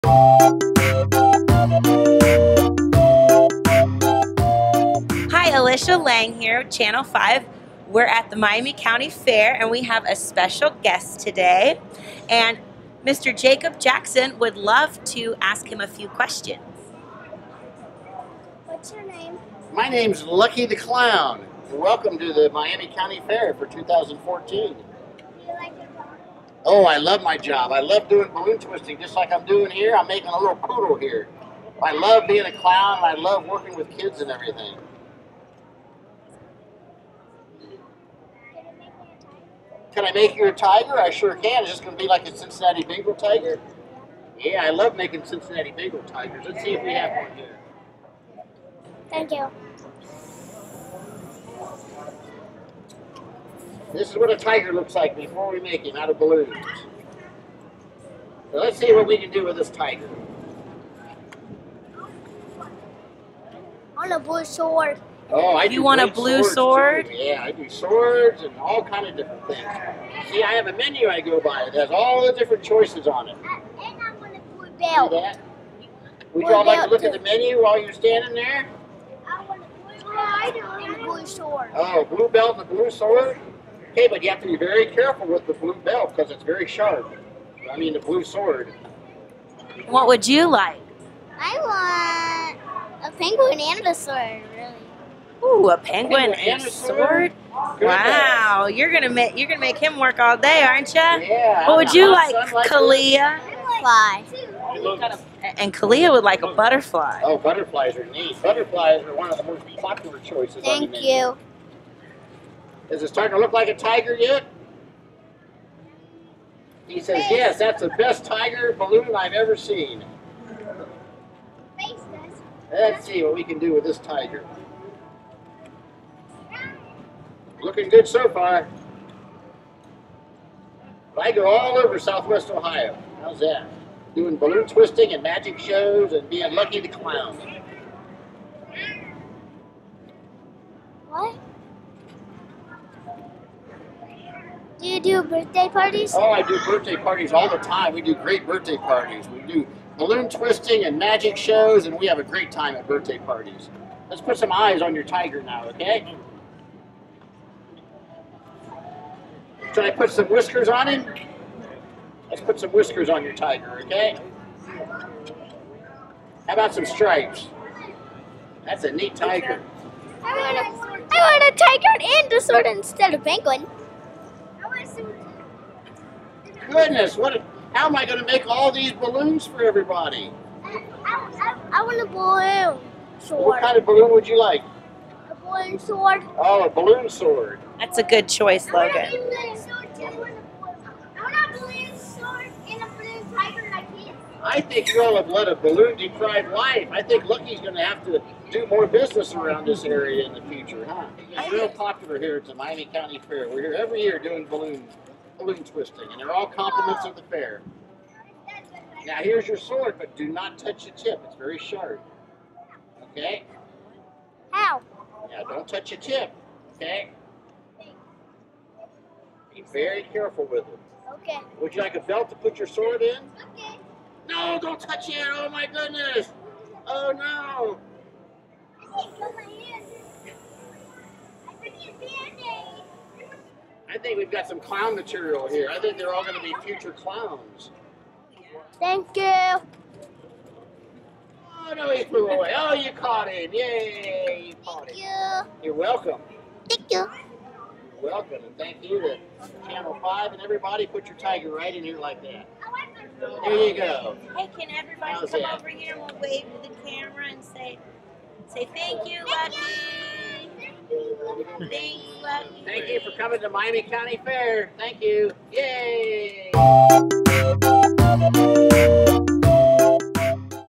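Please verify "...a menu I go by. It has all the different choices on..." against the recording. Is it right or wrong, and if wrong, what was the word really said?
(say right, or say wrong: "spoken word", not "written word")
right.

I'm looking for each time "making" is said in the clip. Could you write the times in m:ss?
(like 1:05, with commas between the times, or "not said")
0:30, 0:44.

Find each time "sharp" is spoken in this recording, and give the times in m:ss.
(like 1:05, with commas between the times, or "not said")
1:26, 3:31.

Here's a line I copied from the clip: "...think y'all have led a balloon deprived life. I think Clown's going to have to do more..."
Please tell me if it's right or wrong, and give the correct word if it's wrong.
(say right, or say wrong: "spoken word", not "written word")
wrong: "Lucky", not "Clown".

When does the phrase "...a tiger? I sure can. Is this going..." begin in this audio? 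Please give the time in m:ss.
0:40.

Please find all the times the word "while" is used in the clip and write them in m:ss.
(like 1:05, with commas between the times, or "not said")
1:17.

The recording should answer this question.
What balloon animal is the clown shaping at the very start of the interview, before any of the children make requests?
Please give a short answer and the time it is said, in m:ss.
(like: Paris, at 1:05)
Poodle, at 0:30.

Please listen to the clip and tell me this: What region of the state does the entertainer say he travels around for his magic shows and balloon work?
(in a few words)
Southwest Ohio.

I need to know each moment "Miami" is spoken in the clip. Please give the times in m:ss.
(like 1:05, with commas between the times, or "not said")
0:08, 0:22, 3:22, 4:23.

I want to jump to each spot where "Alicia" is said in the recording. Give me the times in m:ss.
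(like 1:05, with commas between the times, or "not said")
0:05.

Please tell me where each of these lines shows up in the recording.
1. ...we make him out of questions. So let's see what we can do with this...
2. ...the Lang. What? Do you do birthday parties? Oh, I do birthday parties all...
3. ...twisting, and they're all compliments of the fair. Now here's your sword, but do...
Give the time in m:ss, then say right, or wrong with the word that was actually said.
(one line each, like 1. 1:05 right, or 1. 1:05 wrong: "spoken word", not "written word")
1. 0:55 wrong: "balloons", not "questions"
2. 2:16 wrong: "Clown", not "Lang"
3. 3:25 right.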